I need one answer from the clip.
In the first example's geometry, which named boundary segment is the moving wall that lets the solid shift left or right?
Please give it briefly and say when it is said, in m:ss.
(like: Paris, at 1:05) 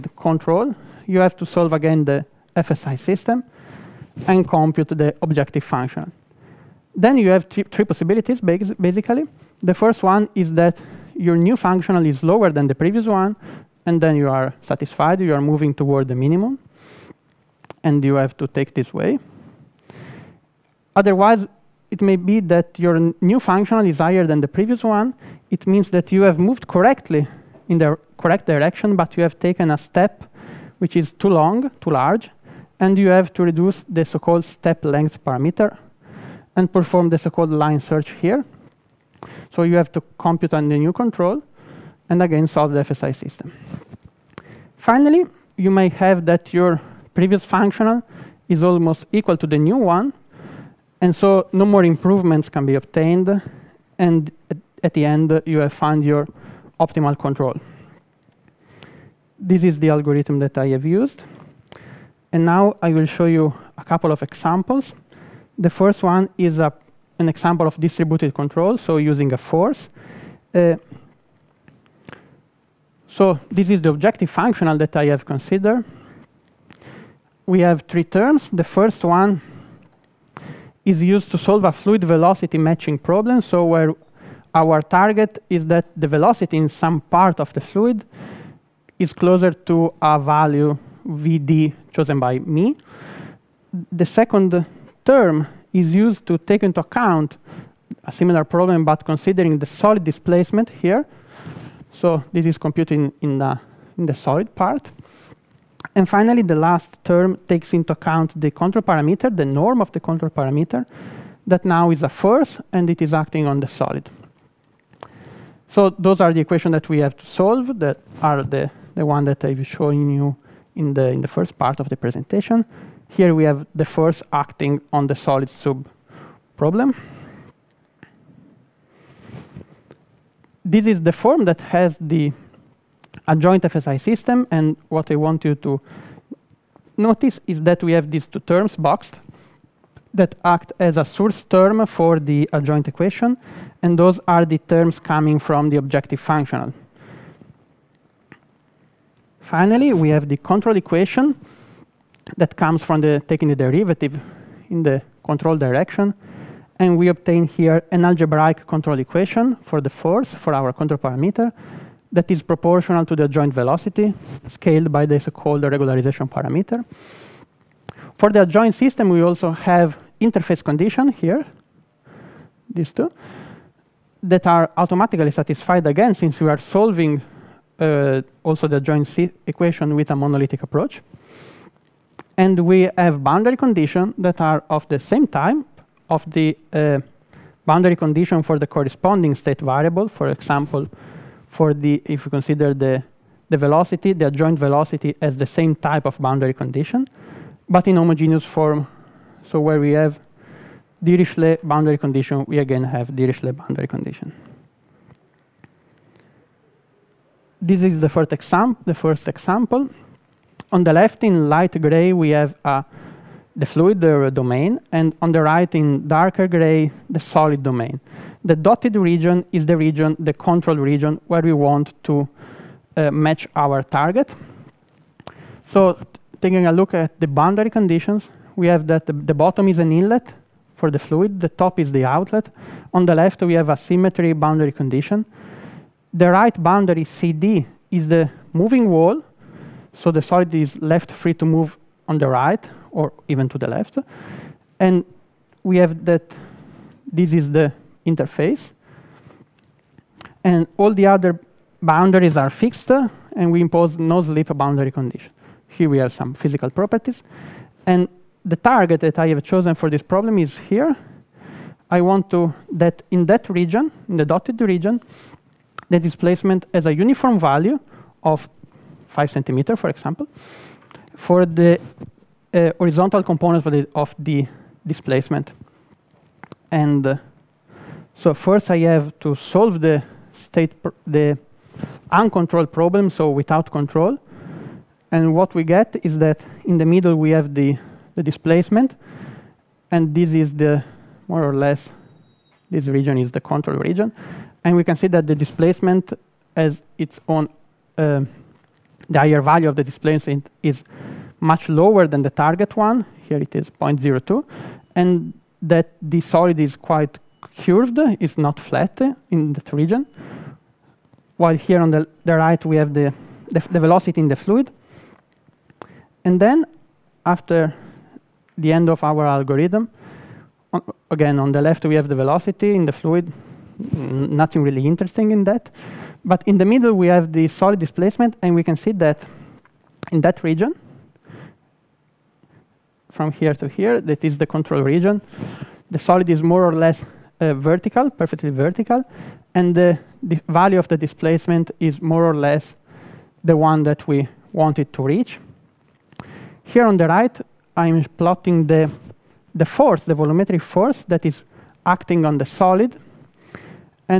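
CD, at 3:57.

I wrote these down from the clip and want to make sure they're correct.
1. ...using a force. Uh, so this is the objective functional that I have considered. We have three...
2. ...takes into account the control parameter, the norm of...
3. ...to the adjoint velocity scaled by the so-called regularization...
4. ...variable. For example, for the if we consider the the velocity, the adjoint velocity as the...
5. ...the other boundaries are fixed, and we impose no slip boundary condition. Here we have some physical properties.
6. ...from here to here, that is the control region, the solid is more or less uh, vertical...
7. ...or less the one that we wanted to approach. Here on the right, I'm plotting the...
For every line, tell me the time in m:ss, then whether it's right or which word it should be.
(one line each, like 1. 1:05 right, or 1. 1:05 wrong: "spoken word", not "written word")
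1. 1:08 right
2. 1:47 right
3. 2:43 right
4. 3:09 right
5. 4:10 right
6. 5:33 right
7. 5:42 wrong: "reach", not "approach".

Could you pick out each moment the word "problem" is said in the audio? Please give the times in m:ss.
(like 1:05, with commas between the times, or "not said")
1:22, 1:38, 2:06, 4:20, 4:42.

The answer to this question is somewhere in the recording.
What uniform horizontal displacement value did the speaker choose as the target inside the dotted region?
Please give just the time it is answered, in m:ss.
4:29.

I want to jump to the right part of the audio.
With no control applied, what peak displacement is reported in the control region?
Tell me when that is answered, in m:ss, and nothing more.
5:03.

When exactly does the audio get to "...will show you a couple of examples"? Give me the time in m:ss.
1:02.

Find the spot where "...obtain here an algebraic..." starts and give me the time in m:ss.
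2:37.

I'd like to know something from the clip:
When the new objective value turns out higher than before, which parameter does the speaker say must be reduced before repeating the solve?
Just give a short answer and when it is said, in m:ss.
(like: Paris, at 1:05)
step length parameter, at 0:34.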